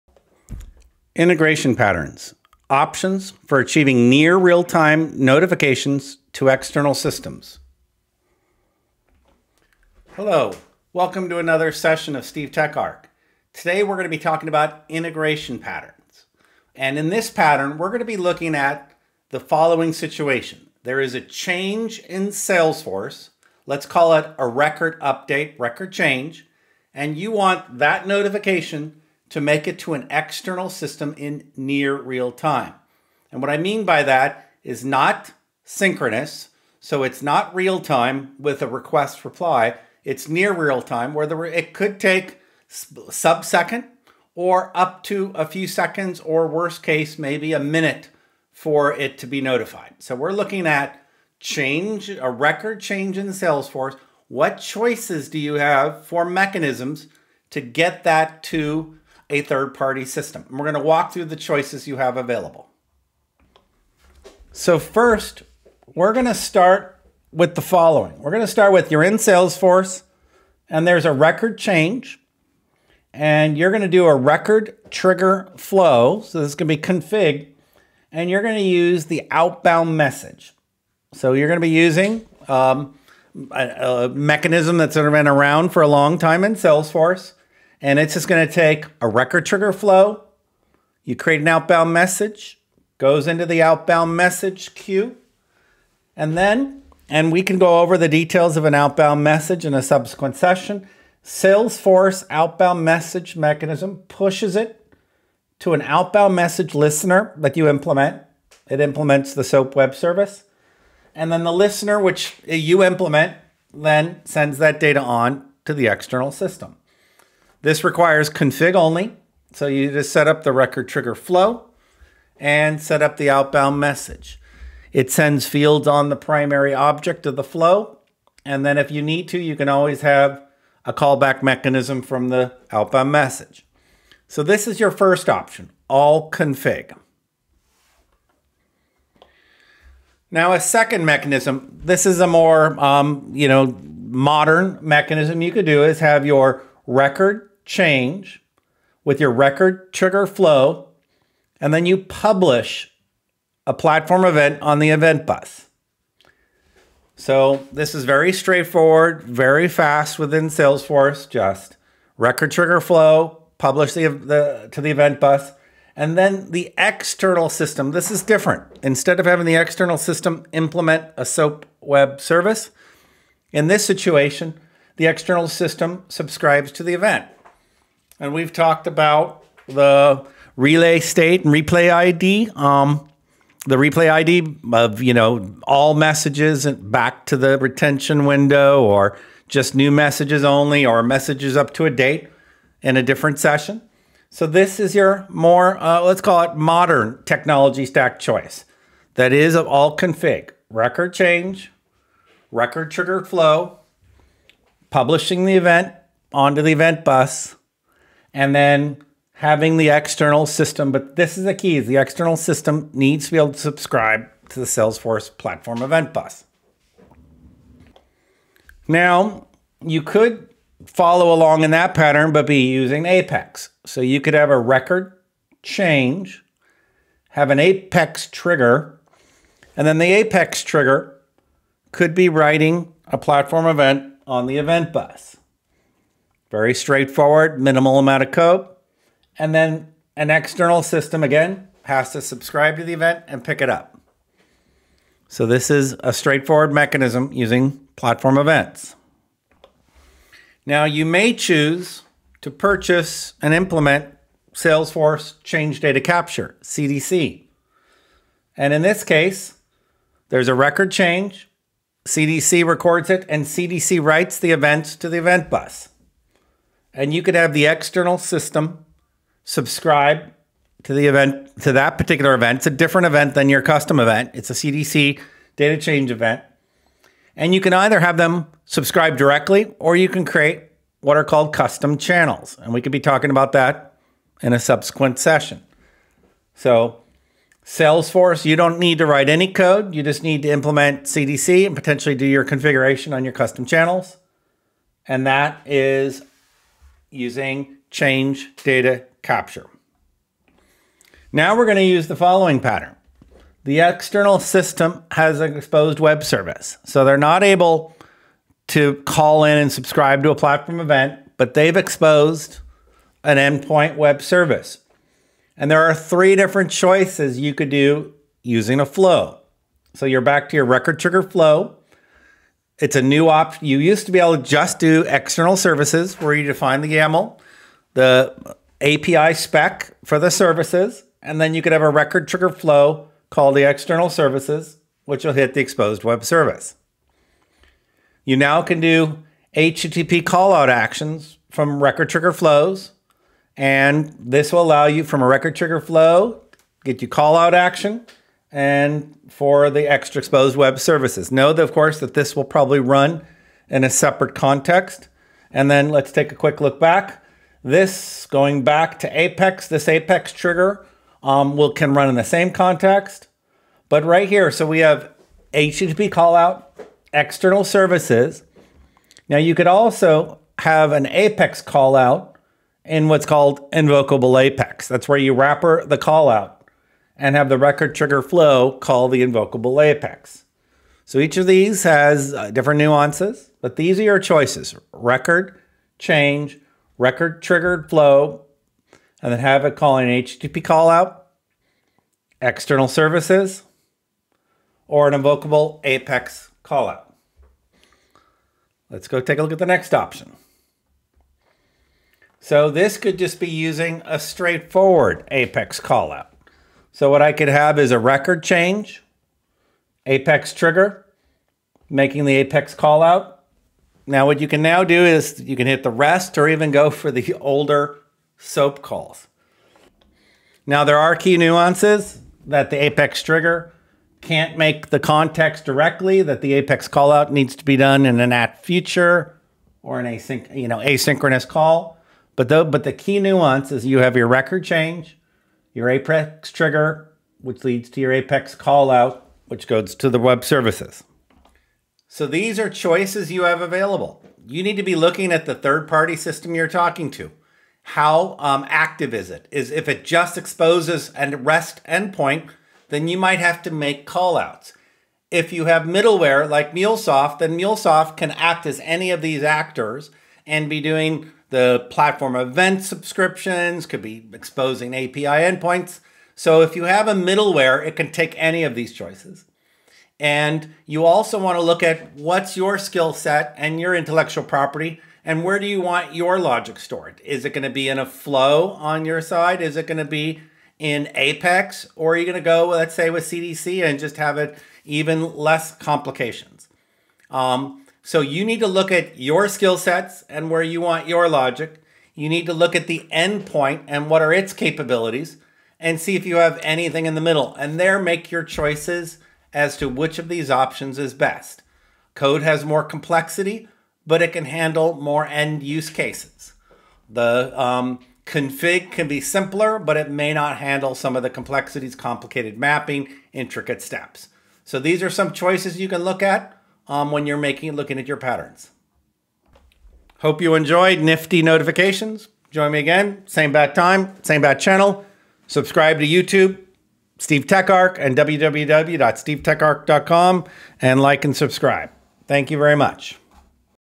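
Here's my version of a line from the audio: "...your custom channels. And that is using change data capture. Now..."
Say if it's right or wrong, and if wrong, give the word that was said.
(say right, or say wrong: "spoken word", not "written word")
right.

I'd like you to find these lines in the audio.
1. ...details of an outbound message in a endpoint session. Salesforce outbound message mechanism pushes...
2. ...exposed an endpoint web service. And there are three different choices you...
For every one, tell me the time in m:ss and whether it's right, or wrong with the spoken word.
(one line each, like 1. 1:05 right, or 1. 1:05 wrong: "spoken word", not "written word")
1. 1:38 wrong: "subsequent", not "endpoint"
2. 5:11 right.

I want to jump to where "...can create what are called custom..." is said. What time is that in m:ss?
4:40.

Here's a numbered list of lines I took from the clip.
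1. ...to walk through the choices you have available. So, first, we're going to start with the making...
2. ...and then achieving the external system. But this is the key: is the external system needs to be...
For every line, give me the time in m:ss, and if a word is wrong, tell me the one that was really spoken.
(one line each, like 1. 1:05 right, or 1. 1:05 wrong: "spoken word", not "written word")
1. 1:00 wrong: "following", not "making"
2. 3:28 wrong: "having", not "achieving".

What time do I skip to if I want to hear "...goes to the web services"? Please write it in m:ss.
7:19.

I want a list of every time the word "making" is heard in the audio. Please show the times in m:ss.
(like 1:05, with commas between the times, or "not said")
6:51, 8:37.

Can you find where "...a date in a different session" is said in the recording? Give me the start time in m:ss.
3:11.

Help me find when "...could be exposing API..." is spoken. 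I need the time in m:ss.
7:43.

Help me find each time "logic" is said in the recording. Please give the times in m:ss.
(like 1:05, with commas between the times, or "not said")
7:56, 8:11.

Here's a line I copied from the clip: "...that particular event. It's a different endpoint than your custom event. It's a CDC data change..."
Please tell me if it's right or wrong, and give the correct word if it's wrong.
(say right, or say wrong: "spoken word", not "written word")
wrong: "event", not "endpoint".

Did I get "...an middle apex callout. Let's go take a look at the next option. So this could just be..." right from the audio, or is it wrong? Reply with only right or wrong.
wrong.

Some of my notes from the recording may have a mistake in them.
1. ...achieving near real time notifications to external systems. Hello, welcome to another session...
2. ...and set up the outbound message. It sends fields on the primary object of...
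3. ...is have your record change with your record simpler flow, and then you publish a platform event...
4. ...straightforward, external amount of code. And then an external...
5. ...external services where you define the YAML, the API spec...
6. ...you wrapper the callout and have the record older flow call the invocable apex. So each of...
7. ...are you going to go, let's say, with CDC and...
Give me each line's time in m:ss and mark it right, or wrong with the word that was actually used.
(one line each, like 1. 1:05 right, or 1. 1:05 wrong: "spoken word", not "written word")
1. 0:03 right
2. 2:02 right
3. 2:25 wrong: "trigger", not "simpler"
4. 3:56 wrong: "minimal", not "external"
5. 5:25 right
6. 6:15 wrong: "trigger", not "older"
7. 8:02 right.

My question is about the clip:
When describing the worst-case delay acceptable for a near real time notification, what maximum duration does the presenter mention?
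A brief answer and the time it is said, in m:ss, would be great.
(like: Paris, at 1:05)
a minute, at 0:47.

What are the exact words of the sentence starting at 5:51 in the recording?
Know that, of course, that this will probably run in a separate context.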